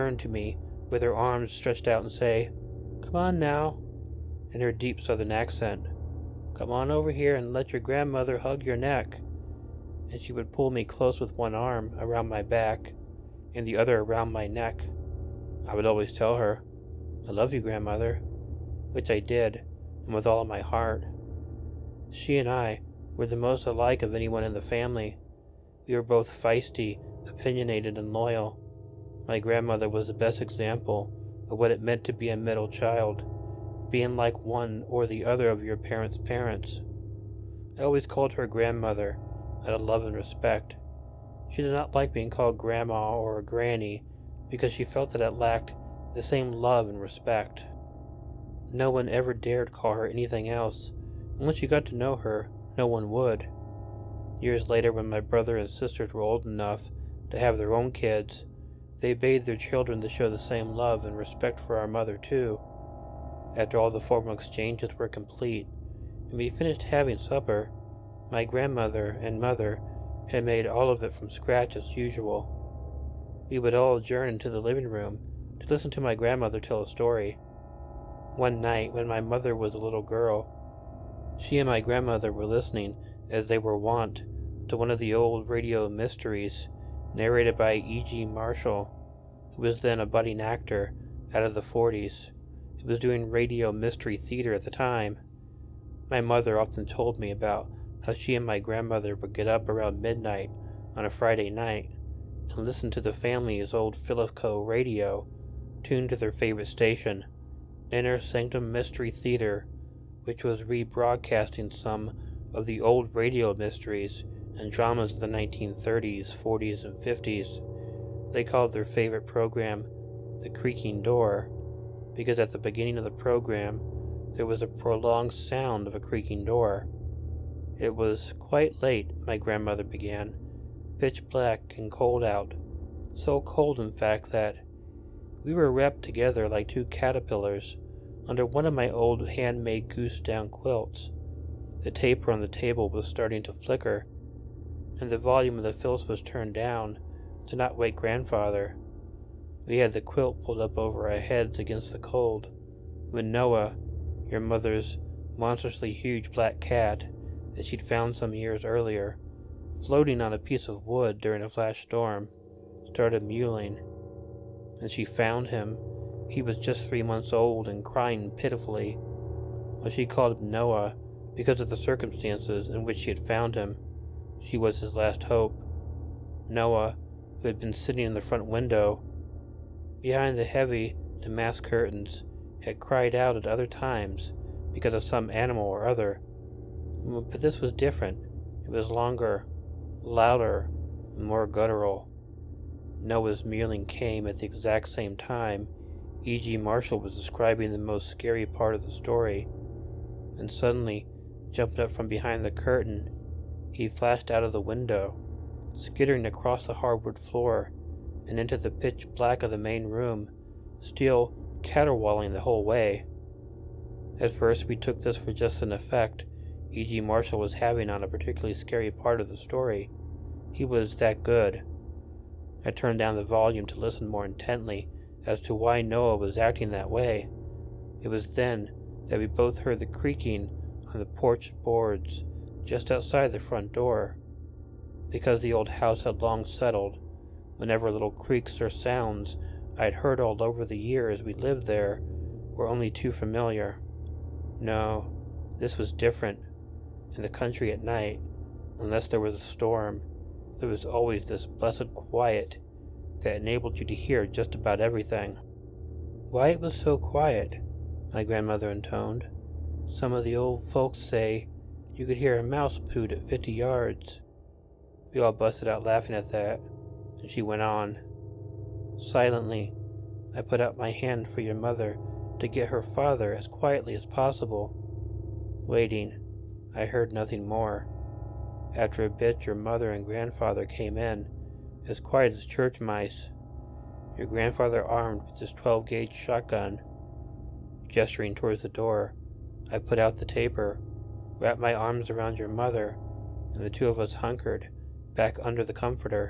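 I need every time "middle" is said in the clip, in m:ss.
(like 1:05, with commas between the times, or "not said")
0:32.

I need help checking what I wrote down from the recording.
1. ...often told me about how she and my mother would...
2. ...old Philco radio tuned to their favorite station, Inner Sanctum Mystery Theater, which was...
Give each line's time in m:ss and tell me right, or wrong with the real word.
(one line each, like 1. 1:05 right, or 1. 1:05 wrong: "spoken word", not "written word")
1. 1:36 wrong: "grandmother", not "mother"
2. 1:43 right.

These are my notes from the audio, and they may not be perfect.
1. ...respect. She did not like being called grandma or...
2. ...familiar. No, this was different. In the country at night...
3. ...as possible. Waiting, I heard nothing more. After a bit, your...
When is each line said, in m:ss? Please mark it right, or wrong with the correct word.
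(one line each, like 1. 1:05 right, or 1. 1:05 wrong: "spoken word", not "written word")
1. 0:40 right
2. 4:03 right
3. 4:33 right.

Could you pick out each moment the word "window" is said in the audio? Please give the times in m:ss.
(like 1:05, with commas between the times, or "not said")
2:58, 3:24.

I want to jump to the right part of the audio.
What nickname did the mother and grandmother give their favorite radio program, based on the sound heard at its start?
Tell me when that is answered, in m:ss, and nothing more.
2:00.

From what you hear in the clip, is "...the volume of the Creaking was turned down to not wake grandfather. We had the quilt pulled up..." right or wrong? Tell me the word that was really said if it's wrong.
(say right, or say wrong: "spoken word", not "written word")
wrong: "Philco", not "Creaking".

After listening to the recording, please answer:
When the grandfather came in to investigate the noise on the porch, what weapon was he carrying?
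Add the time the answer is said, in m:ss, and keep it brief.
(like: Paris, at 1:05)
12 gauge shotgun, at 4:45.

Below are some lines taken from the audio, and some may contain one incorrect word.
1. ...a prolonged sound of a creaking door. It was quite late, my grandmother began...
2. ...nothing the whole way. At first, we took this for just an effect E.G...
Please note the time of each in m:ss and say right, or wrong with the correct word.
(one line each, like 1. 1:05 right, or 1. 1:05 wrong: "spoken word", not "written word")
1. 2:04 right
2. 3:31 wrong: "caterwauling", not "nothing".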